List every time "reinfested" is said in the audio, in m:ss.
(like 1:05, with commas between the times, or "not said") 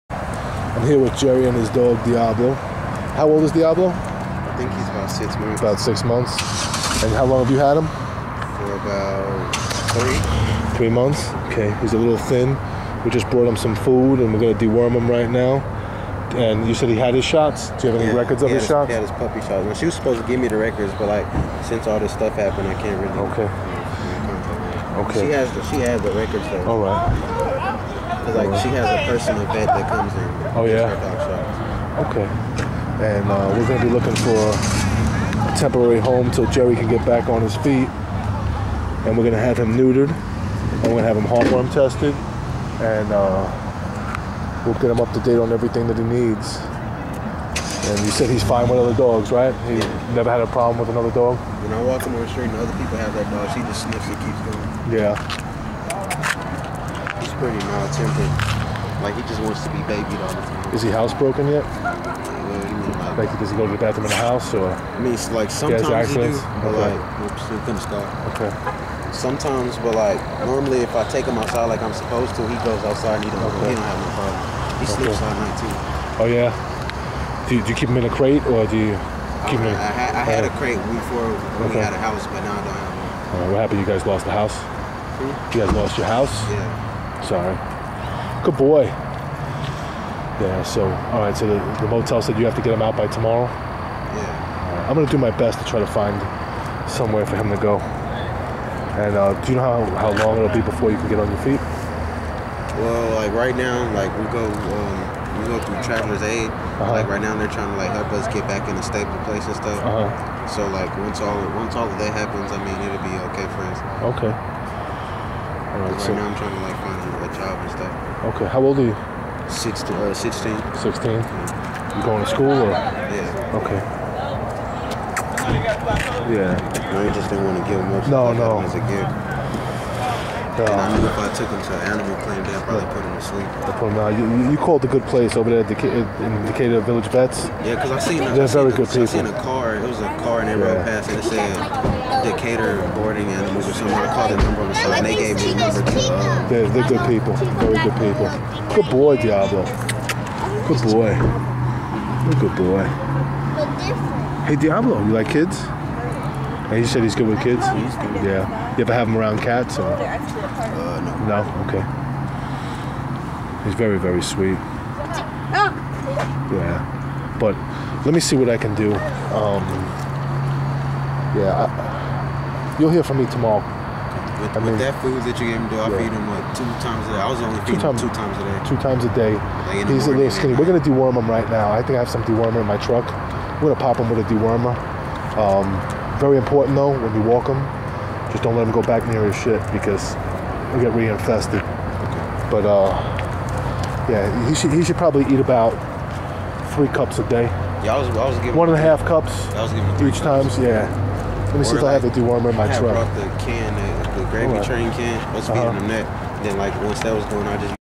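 3:10.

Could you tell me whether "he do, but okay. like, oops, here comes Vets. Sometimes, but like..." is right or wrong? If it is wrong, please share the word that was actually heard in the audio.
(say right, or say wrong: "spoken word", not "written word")
wrong: "Okay", not "Vets".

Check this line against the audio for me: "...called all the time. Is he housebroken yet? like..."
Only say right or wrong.
wrong.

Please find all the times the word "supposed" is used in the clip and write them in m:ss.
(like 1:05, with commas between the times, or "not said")
0:19, 1:11.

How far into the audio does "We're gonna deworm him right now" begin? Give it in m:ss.
3:00.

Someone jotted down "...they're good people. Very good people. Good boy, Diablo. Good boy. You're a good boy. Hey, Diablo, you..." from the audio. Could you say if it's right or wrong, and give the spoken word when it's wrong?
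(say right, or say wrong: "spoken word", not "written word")
right.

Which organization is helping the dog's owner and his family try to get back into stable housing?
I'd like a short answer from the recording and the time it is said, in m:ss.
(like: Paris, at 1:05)
Travelers Aid, at 1:45.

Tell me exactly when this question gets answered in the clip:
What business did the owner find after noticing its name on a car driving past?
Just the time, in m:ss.
2:16.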